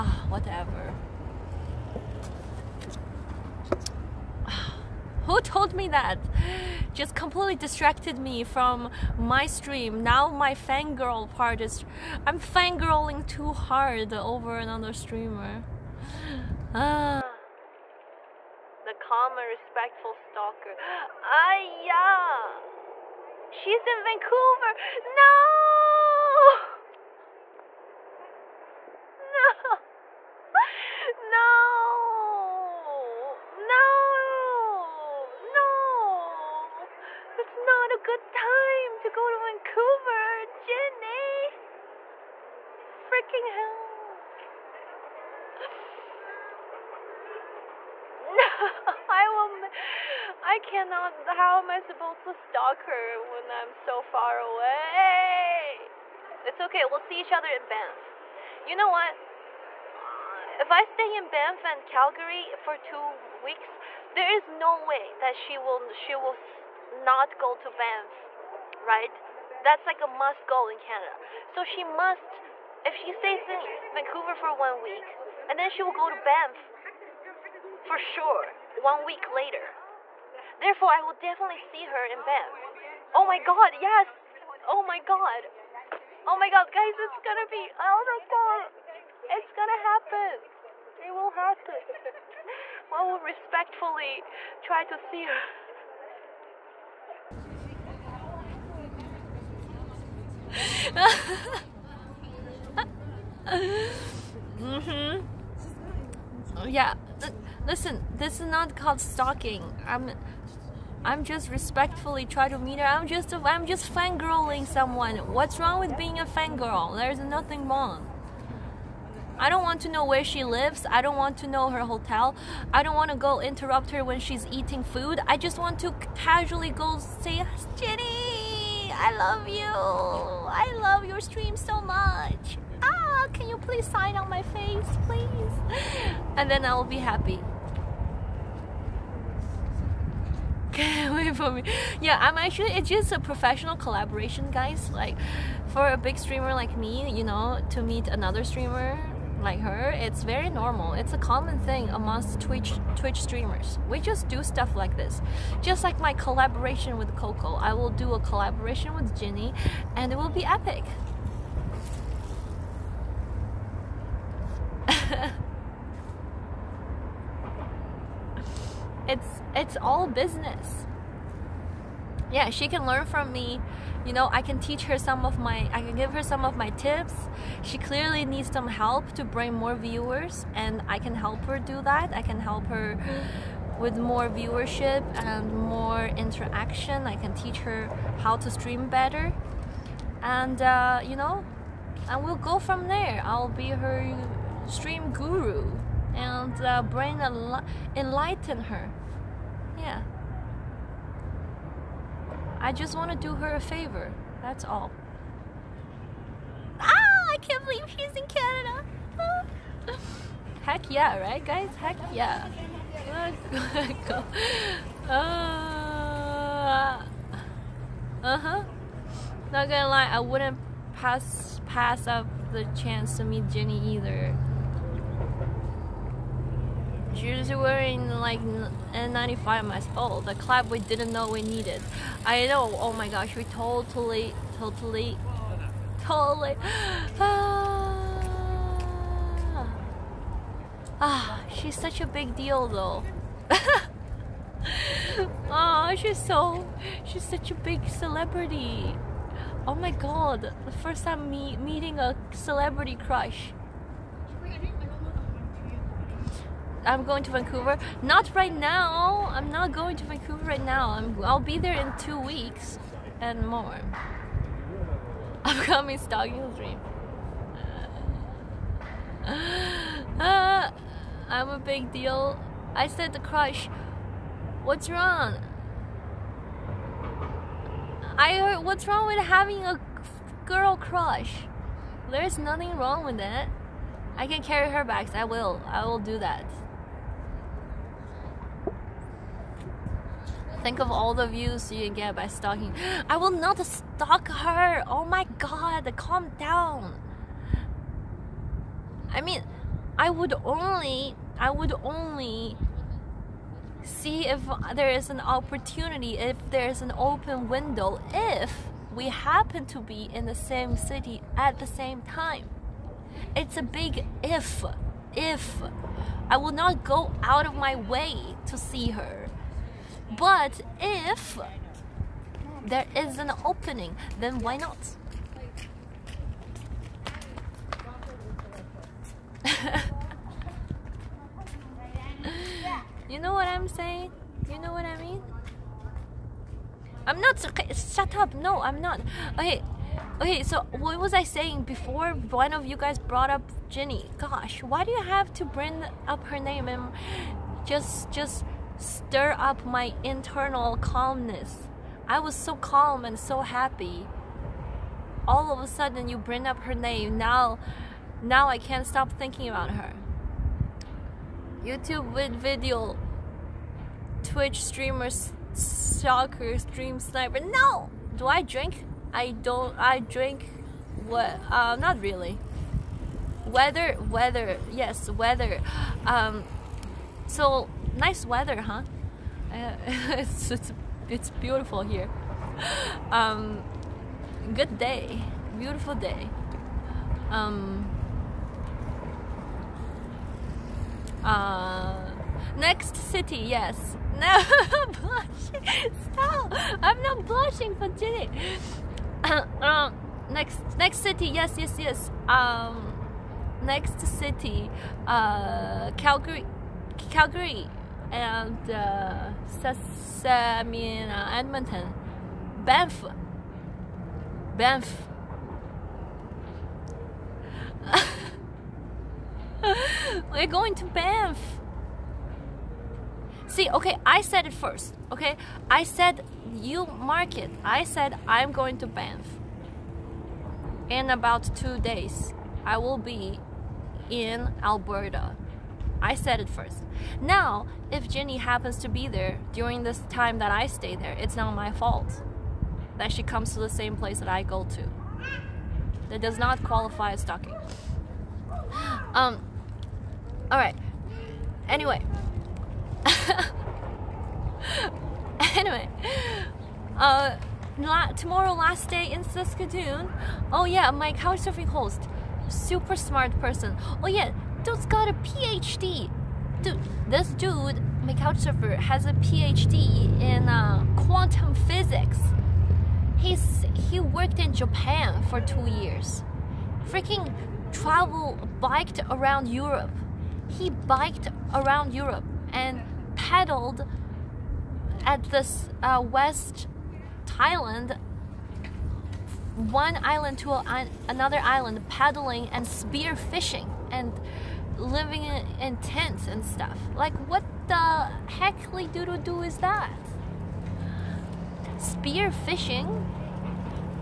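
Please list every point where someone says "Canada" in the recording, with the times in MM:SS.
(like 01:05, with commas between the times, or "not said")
01:10, 03:28.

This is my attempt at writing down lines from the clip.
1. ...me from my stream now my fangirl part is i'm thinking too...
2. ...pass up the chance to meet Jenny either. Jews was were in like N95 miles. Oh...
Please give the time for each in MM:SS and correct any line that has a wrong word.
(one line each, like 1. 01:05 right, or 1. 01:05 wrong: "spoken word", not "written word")
1. 00:08 wrong: "fangirling", not "thinking"
2. 03:41 right.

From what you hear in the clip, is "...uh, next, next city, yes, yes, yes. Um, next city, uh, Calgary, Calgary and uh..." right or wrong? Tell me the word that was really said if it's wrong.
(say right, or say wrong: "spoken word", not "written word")
right.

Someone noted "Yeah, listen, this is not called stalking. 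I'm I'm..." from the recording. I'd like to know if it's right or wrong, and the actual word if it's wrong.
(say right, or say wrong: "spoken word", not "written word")
right.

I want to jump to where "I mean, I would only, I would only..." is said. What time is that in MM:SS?
04:59.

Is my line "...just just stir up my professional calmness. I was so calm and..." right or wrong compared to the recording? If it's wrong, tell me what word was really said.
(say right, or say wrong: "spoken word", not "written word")
wrong: "internal", not "professional".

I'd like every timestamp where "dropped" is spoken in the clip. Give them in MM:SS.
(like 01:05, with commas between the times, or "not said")
not said.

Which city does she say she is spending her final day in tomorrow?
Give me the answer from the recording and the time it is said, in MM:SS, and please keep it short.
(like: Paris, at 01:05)
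Saskatoon, at 07:39.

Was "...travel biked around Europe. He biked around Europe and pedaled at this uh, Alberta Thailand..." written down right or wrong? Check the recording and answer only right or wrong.
wrong.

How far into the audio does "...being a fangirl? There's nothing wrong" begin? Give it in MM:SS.
01:55.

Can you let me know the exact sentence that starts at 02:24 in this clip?
Like for a big streamer like me, you know, to meet another streamer like her, it's very normal.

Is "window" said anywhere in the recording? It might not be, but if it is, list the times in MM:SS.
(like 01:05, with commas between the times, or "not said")
05:07.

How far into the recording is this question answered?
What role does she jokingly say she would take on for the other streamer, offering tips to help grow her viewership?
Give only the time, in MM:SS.
03:14.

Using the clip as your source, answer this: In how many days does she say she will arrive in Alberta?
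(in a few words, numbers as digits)
2.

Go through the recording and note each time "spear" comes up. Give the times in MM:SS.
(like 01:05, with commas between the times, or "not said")
08:12, 08:21.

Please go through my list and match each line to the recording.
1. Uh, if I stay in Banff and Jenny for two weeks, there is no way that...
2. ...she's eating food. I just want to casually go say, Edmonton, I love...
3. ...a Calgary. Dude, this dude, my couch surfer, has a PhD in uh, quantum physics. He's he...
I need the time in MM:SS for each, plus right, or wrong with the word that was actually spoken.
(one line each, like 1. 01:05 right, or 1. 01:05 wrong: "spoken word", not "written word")
1. 00:59 wrong: "Calgary", not "Jenny"
2. 02:04 wrong: "Jenny", not "Edmonton"
3. 07:45 wrong: "PhD", not "Calgary".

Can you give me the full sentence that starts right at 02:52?
Yeah, she can learn from me.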